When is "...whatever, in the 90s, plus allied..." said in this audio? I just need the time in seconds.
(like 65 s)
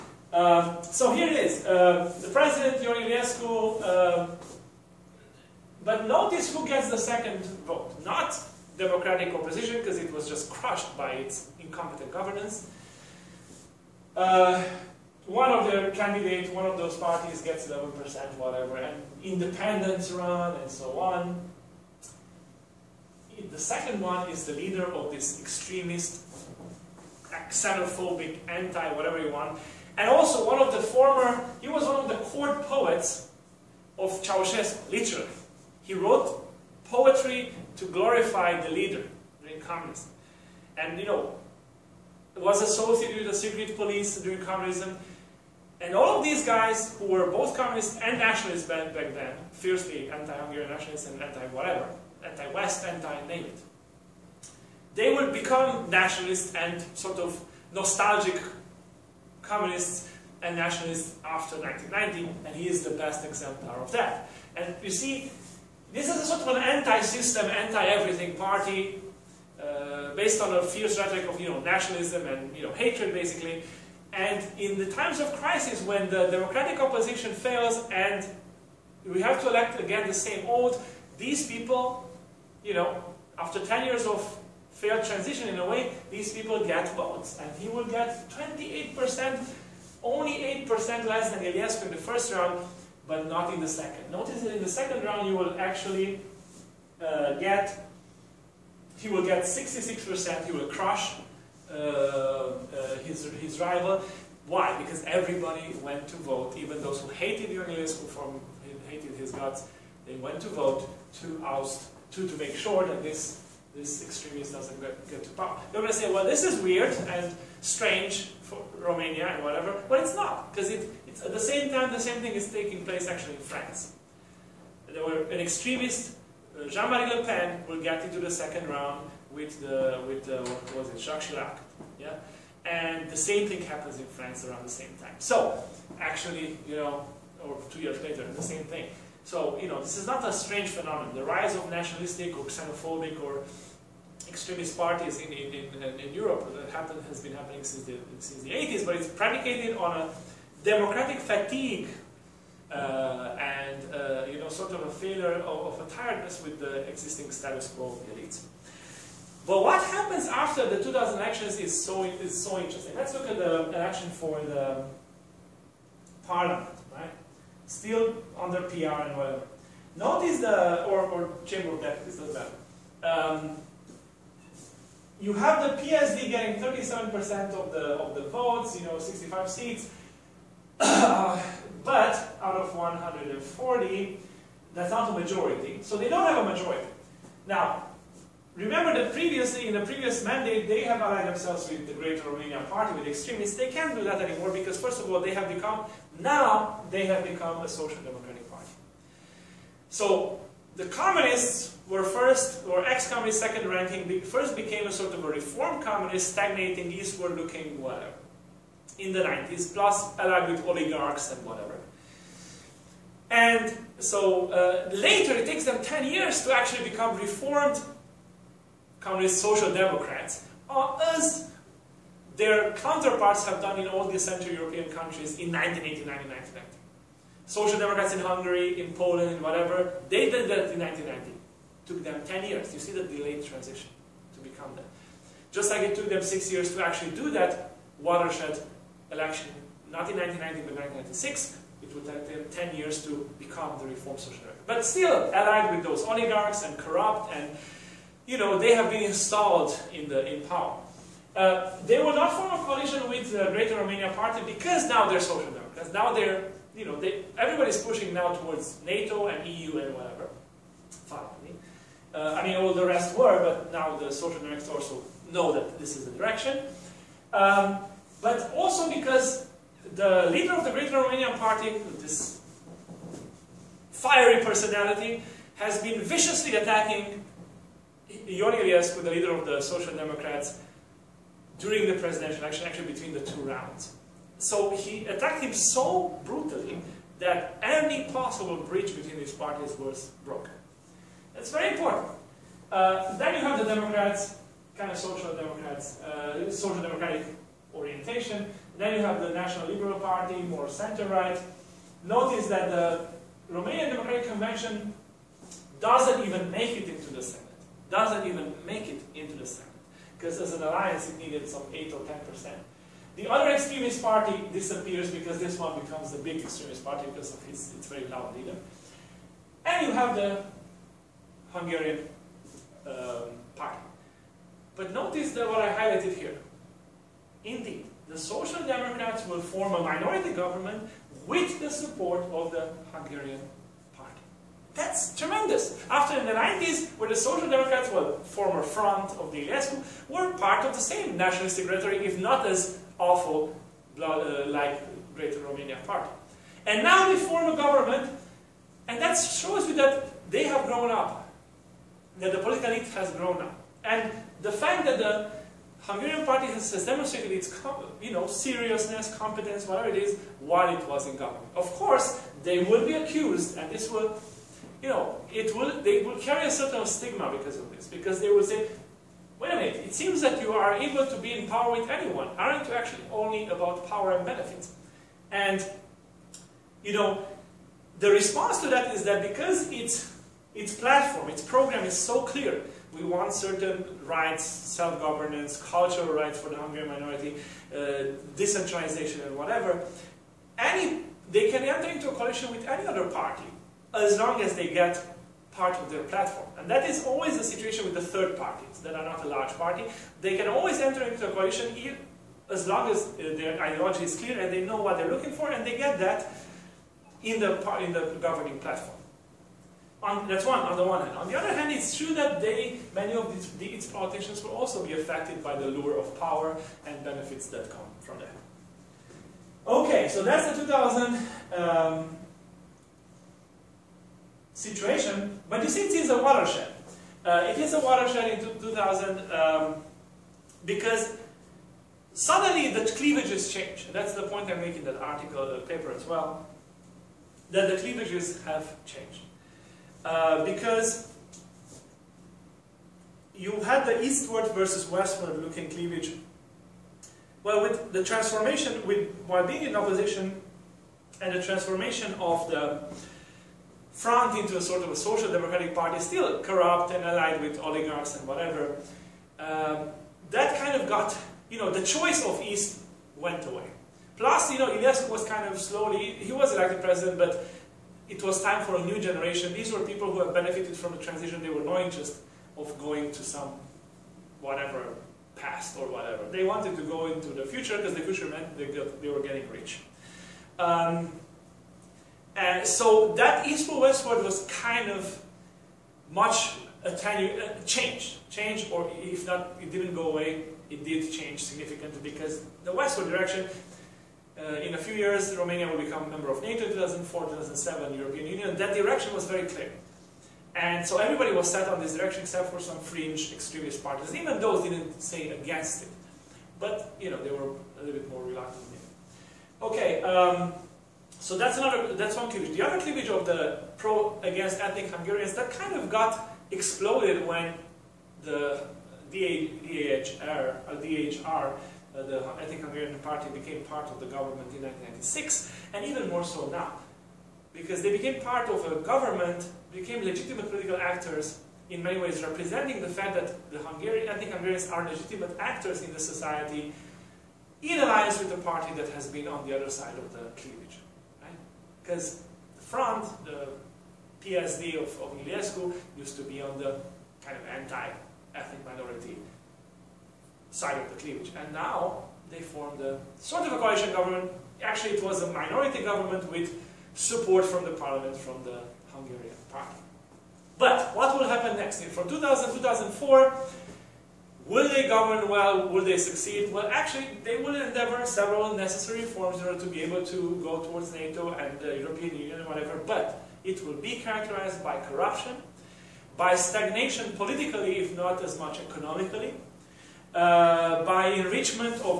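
207 s.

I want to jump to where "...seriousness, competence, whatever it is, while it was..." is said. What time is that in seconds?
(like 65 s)
358 s.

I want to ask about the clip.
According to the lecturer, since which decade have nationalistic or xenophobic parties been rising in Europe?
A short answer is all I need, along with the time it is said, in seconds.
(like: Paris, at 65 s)
the 80s, at 148 s.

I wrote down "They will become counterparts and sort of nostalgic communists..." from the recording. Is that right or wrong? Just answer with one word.
wrong.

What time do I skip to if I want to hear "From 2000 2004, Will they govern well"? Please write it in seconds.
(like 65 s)
561 s.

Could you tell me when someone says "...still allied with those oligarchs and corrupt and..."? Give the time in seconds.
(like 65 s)
244 s.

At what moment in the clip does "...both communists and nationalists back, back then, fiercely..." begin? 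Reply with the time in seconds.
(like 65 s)
47 s.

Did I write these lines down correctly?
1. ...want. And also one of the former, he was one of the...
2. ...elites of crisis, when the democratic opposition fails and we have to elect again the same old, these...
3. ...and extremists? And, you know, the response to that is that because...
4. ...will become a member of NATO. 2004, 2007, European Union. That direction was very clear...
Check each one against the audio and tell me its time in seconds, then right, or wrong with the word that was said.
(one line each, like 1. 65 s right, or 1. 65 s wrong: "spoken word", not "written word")
1. 29 s right
2. 74 s wrong: "times", not "elites"
3. 374 s wrong: "benefits", not "extremists"
4. 495 s right.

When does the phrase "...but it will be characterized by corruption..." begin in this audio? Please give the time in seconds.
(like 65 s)
572 s.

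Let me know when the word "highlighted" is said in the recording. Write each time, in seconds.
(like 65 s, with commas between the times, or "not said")
325 s.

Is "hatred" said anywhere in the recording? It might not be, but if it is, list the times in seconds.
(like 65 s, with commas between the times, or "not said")
72 s.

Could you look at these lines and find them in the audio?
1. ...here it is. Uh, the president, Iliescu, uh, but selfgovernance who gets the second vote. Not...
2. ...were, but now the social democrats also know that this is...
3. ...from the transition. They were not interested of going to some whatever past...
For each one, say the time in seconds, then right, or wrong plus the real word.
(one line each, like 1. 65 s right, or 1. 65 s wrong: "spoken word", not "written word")
1. 1 s wrong: "notice", not "selfgovernance"
2. 263 s right
3. 470 s right.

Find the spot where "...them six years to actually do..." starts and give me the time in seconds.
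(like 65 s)
236 s.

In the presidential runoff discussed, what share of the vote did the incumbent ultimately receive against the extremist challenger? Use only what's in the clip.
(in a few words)
66%.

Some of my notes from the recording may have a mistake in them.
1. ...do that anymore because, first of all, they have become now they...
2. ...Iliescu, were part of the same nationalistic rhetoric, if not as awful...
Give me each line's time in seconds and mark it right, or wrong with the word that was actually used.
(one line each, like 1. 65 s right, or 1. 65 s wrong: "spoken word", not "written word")
1. 193 s right
2. 339 s right.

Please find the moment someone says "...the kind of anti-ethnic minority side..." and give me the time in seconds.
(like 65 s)
546 s.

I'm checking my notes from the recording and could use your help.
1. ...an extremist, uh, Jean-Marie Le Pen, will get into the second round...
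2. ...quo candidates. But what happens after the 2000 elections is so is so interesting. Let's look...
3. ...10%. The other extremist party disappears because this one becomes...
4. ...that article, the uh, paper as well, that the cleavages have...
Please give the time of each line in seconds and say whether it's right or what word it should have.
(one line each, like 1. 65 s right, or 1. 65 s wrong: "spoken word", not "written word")
1. 125 s right
2. 157 s wrong: "elites", not "candidates"
3. 312 s right
4. 434 s right.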